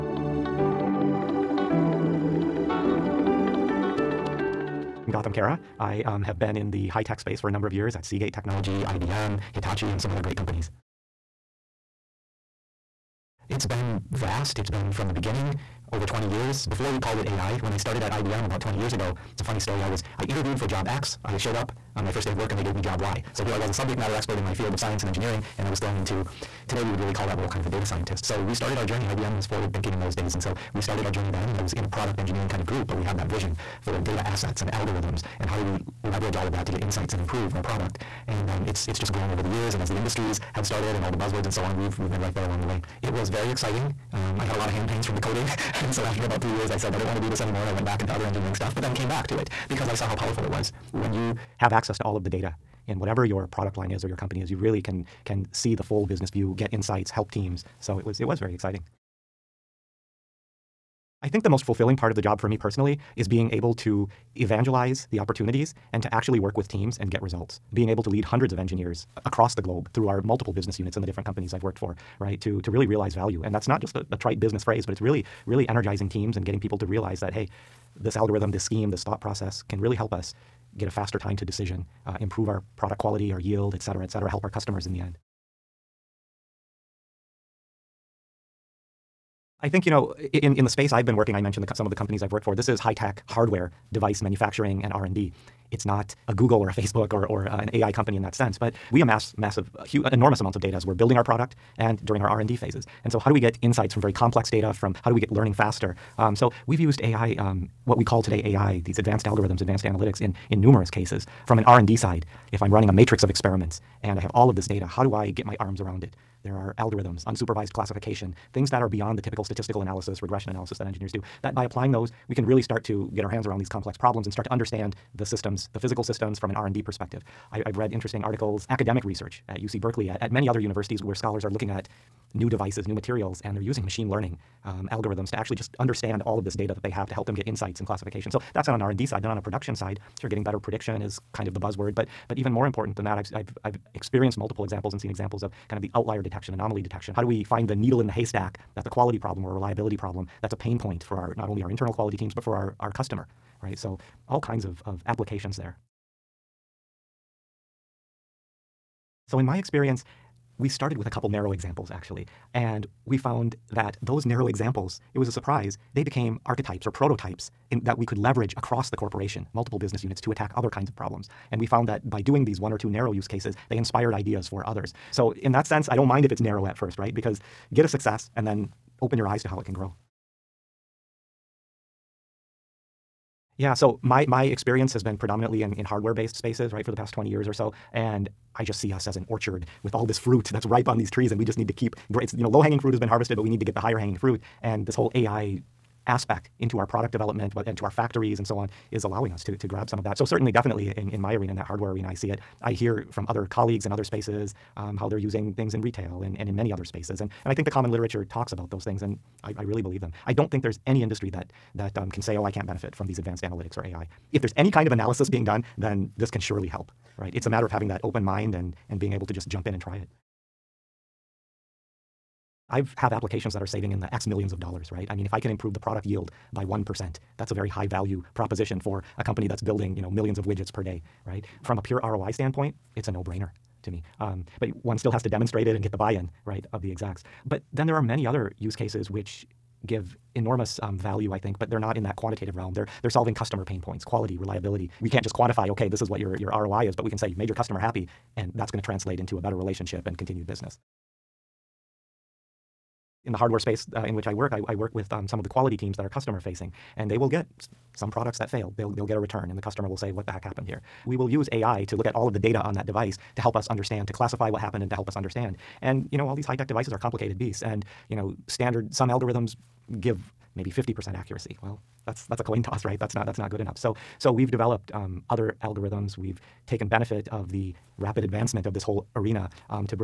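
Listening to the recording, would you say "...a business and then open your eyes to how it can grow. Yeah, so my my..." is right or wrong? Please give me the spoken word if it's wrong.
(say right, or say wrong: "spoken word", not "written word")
wrong: "success", not "business".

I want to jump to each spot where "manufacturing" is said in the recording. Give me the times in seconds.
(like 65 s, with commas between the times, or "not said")
94 s.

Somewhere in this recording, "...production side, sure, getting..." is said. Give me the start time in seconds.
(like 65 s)
139 s.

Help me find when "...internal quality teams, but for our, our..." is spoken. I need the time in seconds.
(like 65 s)
151 s.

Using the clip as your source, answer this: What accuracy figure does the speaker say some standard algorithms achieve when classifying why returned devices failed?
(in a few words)
50%.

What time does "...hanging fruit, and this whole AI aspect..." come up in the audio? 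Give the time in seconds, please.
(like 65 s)
193 s.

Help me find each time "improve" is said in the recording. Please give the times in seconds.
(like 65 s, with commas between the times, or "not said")
37 s, 82 s, 225 s.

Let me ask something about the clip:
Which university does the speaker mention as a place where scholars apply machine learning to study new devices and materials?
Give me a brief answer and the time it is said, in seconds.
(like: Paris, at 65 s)
UC Berkeley, at 129 s.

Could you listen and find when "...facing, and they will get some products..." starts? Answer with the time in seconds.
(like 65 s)
256 s.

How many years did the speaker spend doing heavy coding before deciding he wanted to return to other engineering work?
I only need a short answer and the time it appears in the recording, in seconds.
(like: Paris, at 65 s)
3 years, at 46 s.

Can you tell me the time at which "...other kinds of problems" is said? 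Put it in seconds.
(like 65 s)
170 s.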